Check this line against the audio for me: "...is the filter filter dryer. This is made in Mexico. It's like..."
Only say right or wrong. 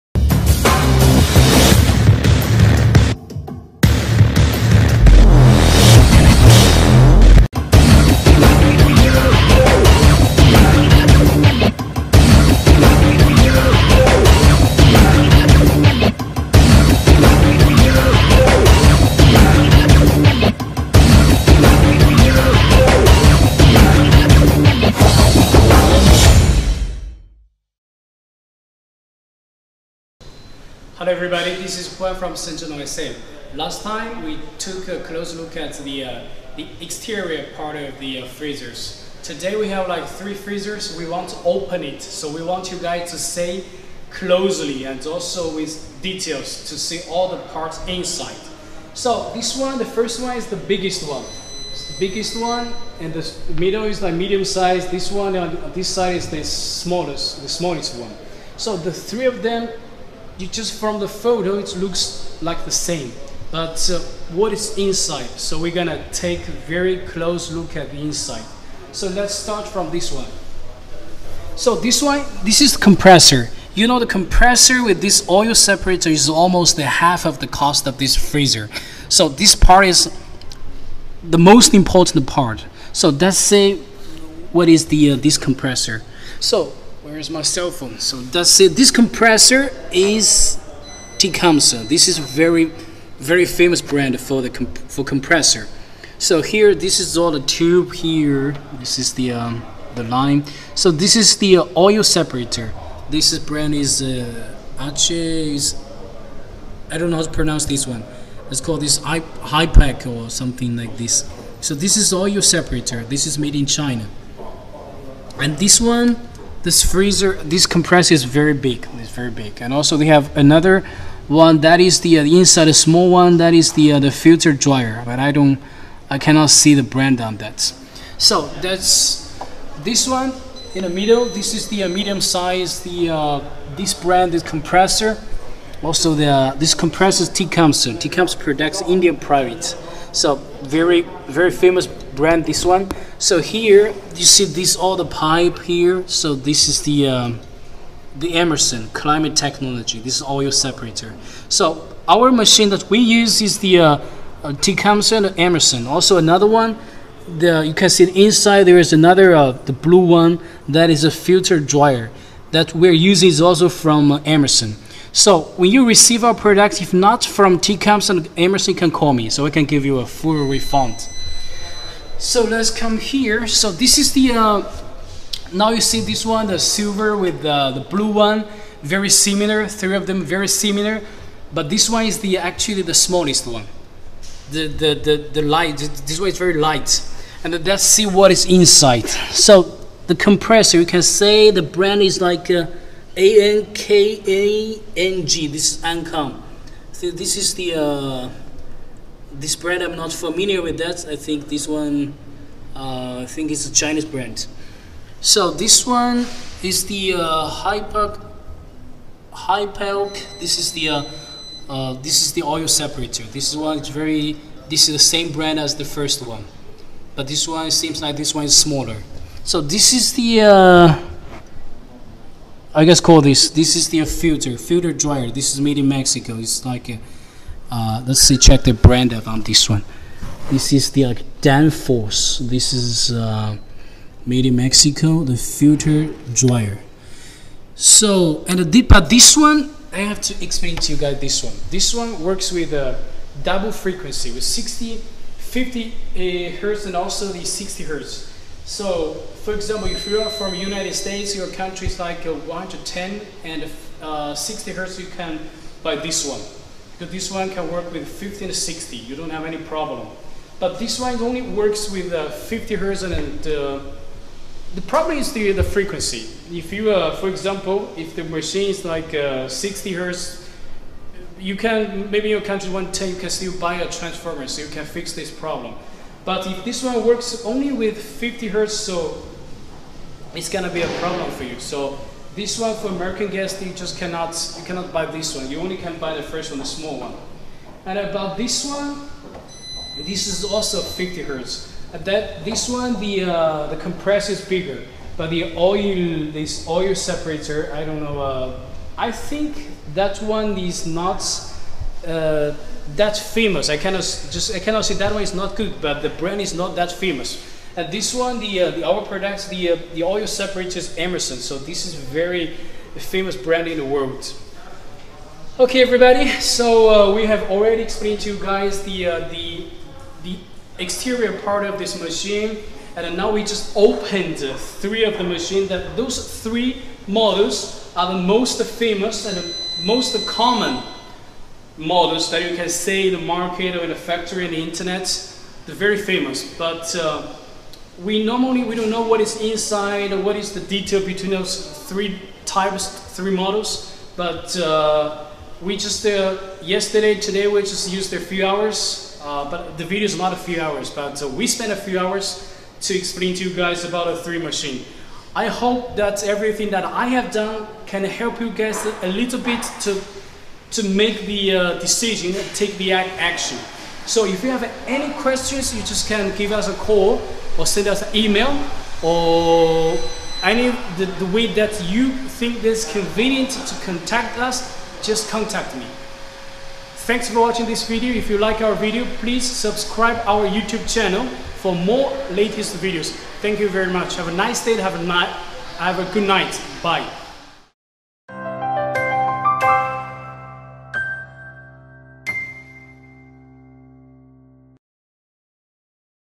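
right.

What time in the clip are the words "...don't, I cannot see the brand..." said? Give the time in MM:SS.
02:05.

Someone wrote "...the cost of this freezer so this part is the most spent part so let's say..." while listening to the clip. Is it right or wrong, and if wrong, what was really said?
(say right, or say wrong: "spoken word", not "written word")
wrong: "important", not "spent".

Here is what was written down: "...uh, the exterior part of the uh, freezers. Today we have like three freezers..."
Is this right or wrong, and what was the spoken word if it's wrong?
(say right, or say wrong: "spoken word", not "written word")
right.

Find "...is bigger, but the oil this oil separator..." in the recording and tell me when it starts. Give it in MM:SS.
04:54.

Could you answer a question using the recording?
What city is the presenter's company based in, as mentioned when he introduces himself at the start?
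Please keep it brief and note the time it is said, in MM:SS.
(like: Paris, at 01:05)
Shenzhen, at 00:32.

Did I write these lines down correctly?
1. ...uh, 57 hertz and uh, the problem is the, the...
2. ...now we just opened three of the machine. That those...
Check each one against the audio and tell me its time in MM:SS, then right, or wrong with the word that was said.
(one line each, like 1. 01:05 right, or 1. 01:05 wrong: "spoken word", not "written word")
1. 04:22 wrong: "50", not "57"
2. 05:23 right.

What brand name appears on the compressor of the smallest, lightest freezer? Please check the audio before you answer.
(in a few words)
Ankang.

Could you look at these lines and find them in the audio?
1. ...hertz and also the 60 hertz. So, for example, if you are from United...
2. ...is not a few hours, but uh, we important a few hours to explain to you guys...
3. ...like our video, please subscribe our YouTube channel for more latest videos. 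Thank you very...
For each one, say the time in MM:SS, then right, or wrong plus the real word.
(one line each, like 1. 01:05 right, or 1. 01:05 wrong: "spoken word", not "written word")
1. 04:06 right
2. 05:50 wrong: "spent", not "important"
3. 06:18 right.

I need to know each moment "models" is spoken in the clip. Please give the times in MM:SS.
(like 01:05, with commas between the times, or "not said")
05:27, 05:31, 05:43.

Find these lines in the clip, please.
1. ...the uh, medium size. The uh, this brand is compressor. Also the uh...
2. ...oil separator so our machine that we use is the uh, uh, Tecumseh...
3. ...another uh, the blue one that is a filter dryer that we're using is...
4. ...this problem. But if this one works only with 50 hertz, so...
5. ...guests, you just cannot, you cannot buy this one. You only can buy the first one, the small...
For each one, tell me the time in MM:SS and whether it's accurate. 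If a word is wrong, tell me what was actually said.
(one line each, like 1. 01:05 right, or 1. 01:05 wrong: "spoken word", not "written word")
1. 02:11 right
2. 02:30 right
3. 02:38 right
4. 04:35 right
5. 04:43 right.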